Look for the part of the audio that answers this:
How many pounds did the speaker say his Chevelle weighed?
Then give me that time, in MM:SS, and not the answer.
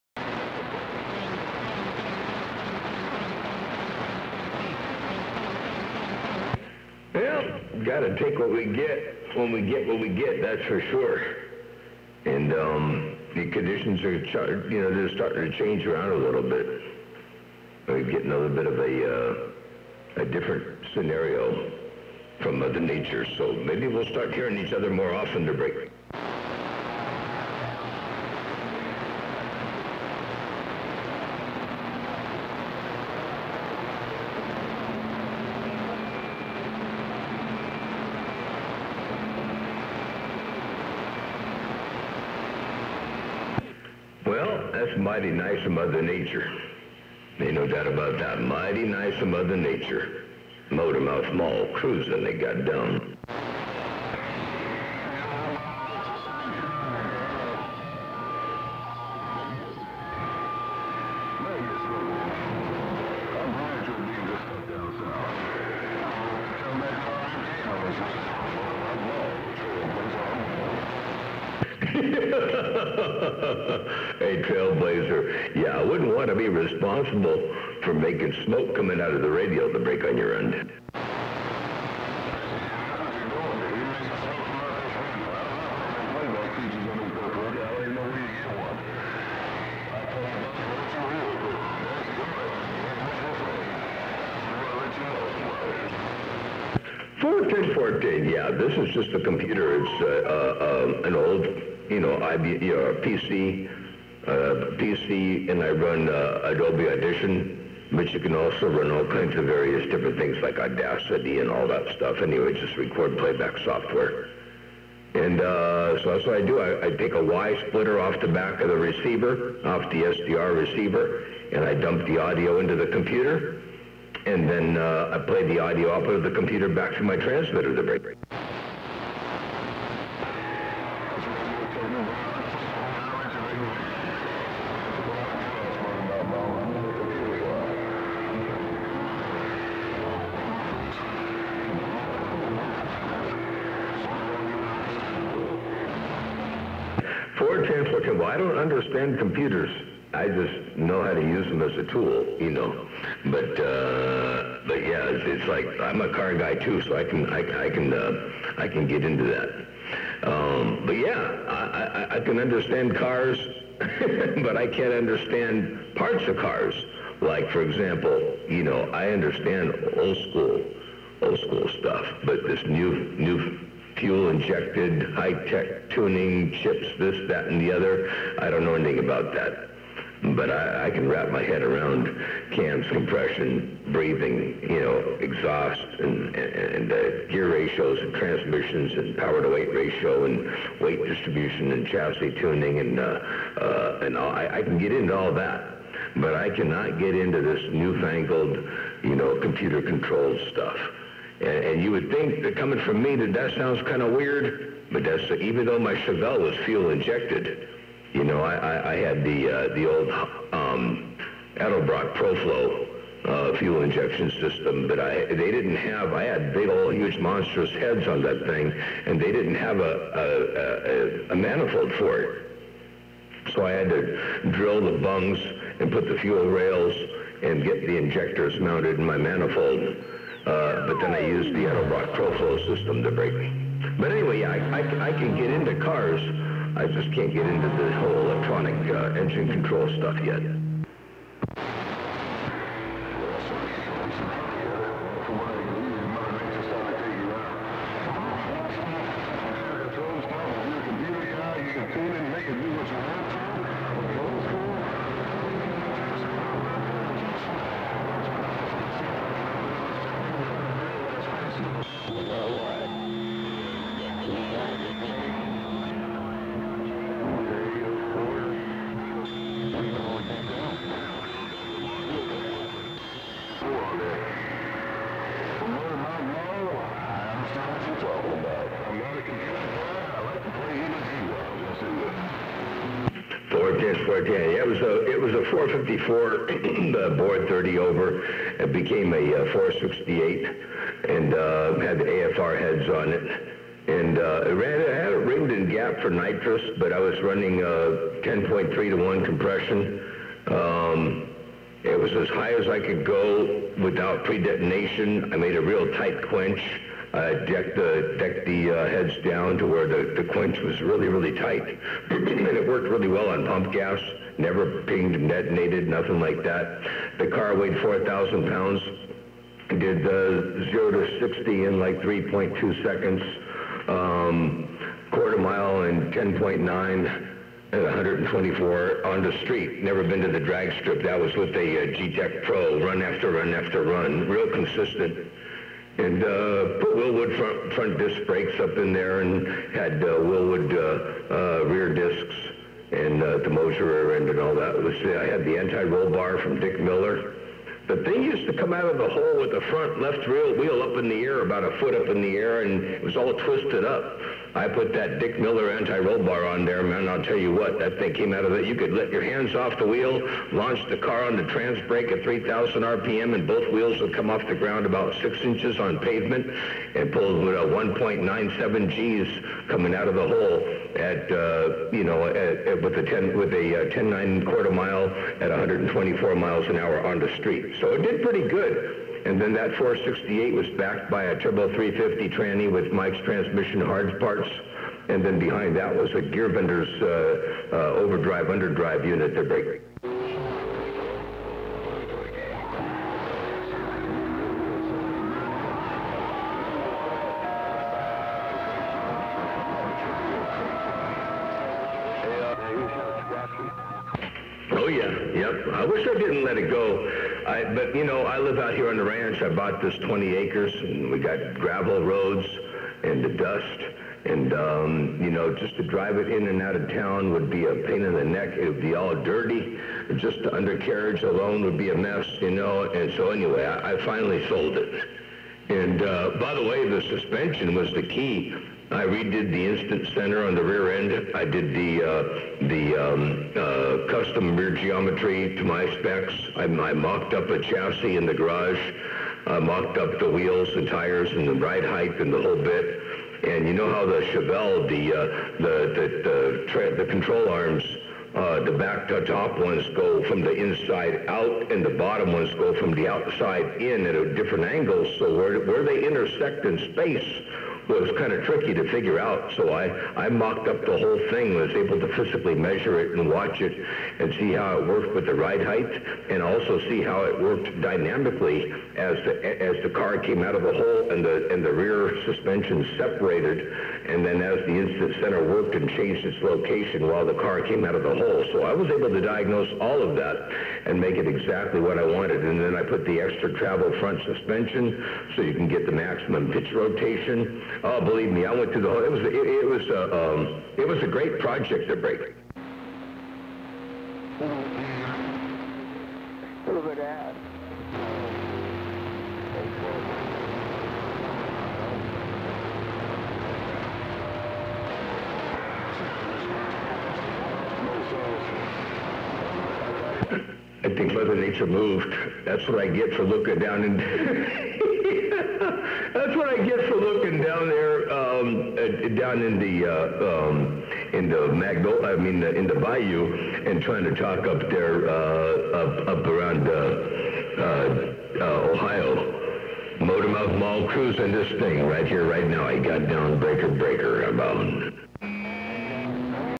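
05:17.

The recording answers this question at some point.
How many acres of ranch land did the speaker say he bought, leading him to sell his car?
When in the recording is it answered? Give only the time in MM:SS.
06:49.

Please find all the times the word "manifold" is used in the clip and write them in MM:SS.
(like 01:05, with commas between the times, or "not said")
03:41, 03:49.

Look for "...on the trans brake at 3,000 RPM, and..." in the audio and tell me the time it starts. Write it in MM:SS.
06:01.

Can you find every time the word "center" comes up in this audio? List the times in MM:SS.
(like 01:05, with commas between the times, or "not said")
07:10, 07:55.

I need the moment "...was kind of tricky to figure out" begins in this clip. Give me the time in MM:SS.
07:37.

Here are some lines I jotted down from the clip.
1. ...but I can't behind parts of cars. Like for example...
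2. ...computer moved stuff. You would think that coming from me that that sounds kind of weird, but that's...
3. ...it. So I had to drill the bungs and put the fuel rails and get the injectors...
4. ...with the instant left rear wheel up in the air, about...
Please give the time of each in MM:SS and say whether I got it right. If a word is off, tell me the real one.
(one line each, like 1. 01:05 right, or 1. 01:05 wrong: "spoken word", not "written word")
1. 02:44 wrong: "understand", not "behind"
2. 03:19 wrong: "controlled", not "moved"
3. 03:42 right
4. 05:49 wrong: "front", not "instant".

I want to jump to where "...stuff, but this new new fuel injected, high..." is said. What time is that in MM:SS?
02:51.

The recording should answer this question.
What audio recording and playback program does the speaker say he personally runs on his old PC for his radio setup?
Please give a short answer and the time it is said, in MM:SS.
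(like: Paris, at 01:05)
Adobe Audition, at 01:46.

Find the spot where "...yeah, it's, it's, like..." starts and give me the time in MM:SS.
02:34.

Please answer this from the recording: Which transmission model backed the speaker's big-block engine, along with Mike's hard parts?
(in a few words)
Turbo 350.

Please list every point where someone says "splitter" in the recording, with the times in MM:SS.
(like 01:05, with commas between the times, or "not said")
01:57.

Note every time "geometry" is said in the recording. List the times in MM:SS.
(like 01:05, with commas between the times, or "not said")
07:14.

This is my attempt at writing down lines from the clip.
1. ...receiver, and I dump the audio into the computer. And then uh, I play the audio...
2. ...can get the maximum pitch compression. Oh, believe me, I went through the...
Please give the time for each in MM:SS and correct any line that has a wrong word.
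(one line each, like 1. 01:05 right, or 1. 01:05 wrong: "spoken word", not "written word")
1. 02:00 right
2. 08:05 wrong: "rotation", not "compression".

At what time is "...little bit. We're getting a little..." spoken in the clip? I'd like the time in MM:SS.
00:16.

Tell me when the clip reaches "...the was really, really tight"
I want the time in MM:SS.
05:10.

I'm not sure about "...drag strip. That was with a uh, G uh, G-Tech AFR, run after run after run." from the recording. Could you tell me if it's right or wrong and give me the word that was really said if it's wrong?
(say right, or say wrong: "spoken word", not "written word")
wrong: "Pro", not "AFR".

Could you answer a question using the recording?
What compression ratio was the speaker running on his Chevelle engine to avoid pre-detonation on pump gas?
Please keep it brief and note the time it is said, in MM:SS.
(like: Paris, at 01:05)
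10.3 to 1, at 04:58.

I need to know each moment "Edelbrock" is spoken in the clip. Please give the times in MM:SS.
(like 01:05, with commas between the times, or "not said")
03:31, 03:51.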